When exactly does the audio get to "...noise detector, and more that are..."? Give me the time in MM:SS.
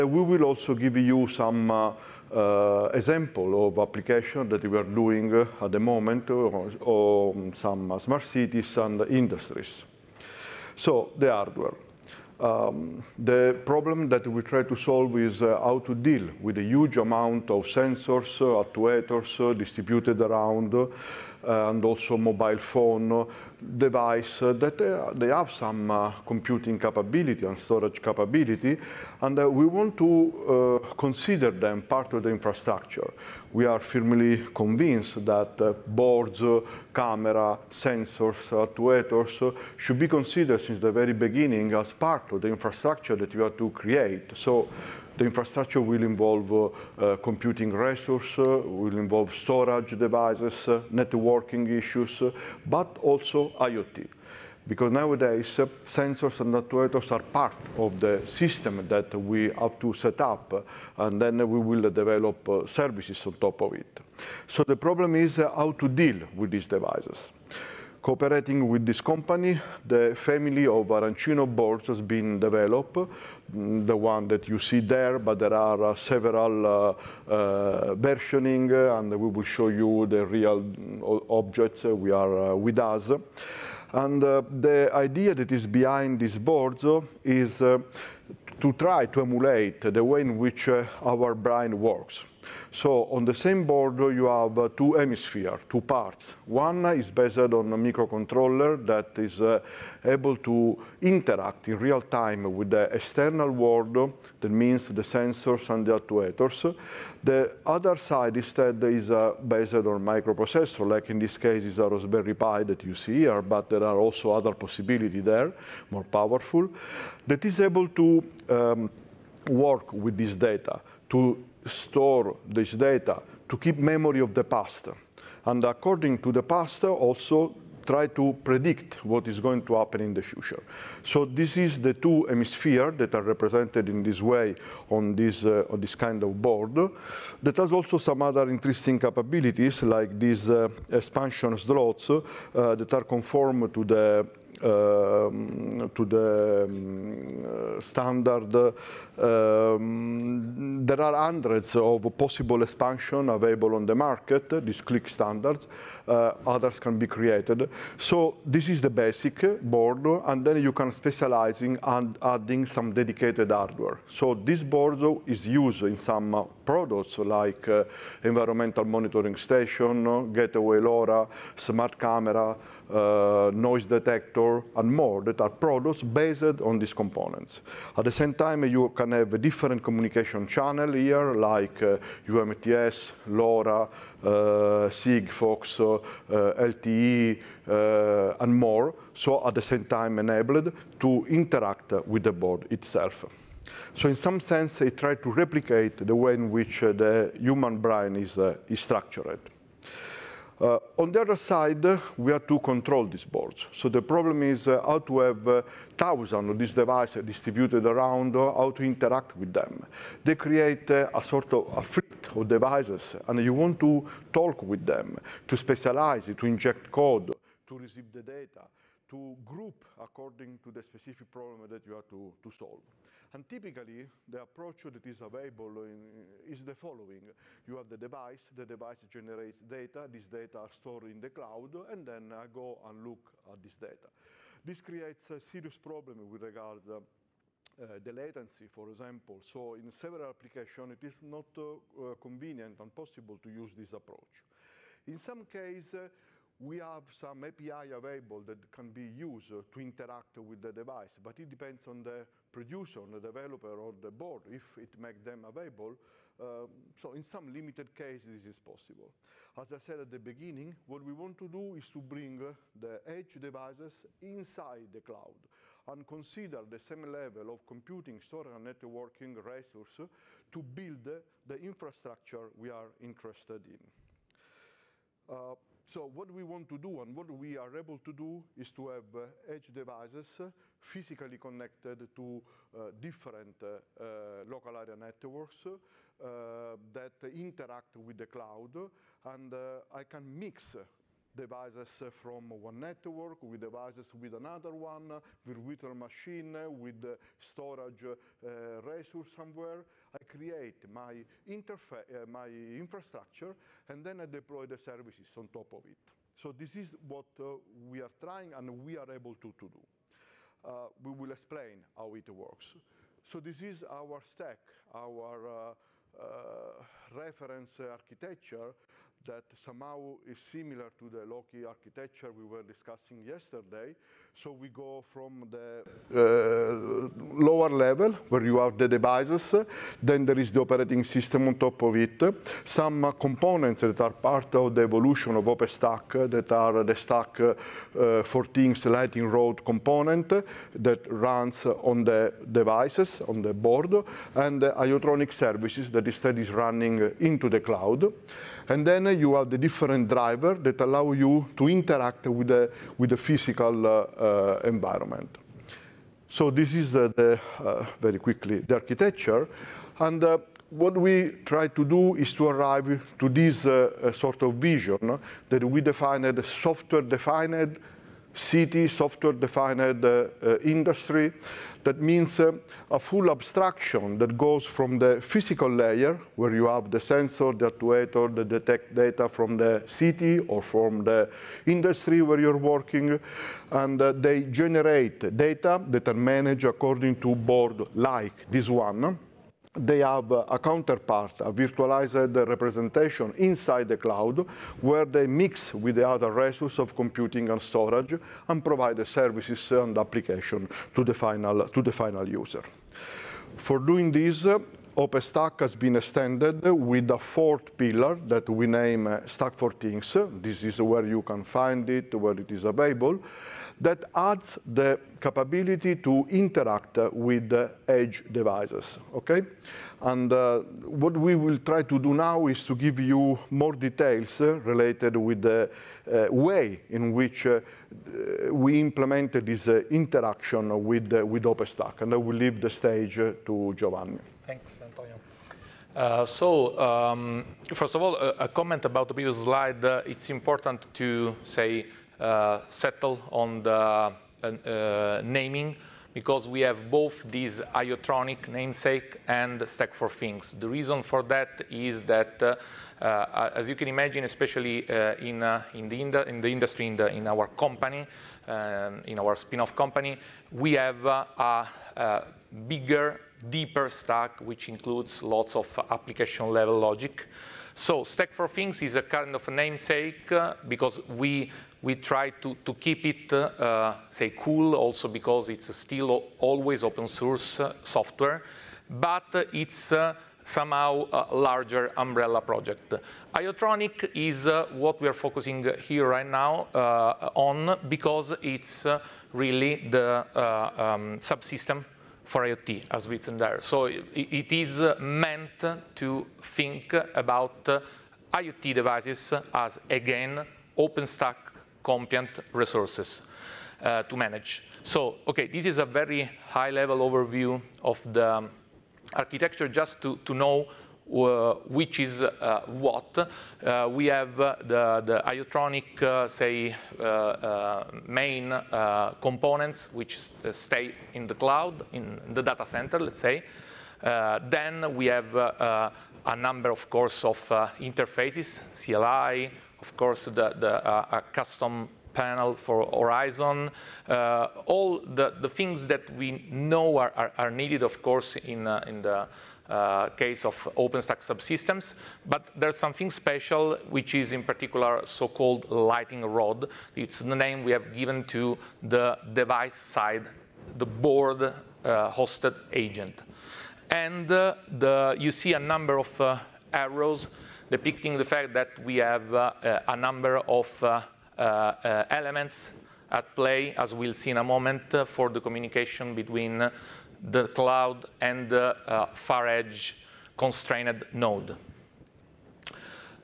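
02:53.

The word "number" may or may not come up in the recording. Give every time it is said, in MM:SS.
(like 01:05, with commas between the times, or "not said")
08:46, 09:15, 09:19.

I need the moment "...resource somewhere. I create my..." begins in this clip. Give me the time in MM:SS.
04:58.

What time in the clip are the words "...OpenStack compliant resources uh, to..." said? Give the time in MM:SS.
08:20.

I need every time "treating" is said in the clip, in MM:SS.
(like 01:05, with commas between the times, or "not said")
not said.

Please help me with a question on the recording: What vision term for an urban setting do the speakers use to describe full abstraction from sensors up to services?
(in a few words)
Software-defined city.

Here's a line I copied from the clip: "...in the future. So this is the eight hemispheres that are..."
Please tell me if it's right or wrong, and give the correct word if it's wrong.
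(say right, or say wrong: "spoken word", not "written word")
wrong: "two", not "eight".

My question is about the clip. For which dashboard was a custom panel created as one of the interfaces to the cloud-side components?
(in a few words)
Horizon.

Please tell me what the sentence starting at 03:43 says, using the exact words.
And typically, the approach that is available in, is the following.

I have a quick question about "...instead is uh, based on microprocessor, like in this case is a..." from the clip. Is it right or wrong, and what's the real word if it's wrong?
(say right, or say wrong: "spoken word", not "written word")
right.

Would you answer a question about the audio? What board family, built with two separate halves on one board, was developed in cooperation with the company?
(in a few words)
Arancino.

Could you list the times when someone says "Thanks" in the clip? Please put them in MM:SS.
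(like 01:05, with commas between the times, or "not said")
07:14.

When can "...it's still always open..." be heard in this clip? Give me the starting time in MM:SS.
07:55.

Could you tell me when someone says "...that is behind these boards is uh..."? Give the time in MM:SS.
01:25.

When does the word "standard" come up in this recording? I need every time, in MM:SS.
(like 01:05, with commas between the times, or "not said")
02:27, 02:35.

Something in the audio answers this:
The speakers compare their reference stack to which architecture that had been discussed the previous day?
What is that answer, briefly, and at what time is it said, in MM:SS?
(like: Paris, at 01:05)
Loki architecture, at 05:21.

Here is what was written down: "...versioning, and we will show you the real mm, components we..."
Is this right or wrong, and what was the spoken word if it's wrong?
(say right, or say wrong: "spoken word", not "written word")
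wrong: "objects", not "components".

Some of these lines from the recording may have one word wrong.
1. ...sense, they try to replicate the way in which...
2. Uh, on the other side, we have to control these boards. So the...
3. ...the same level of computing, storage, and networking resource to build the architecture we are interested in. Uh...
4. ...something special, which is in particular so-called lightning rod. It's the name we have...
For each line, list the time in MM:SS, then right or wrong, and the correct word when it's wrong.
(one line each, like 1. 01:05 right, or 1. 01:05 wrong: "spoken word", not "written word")
1. 03:14 right
2. 03:20 right
3. 04:26 wrong: "infrastructure", not "architecture"
4. 09:02 right.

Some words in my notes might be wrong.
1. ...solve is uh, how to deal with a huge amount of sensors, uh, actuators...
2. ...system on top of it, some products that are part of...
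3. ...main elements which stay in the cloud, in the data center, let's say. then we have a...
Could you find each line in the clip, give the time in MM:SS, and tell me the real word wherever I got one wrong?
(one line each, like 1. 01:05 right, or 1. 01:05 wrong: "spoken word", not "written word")
1. 00:14 right
2. 05:31 wrong: "components", not "products"
3. 08:38 wrong: "components", not "elements".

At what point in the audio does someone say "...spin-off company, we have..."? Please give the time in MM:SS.
07:39.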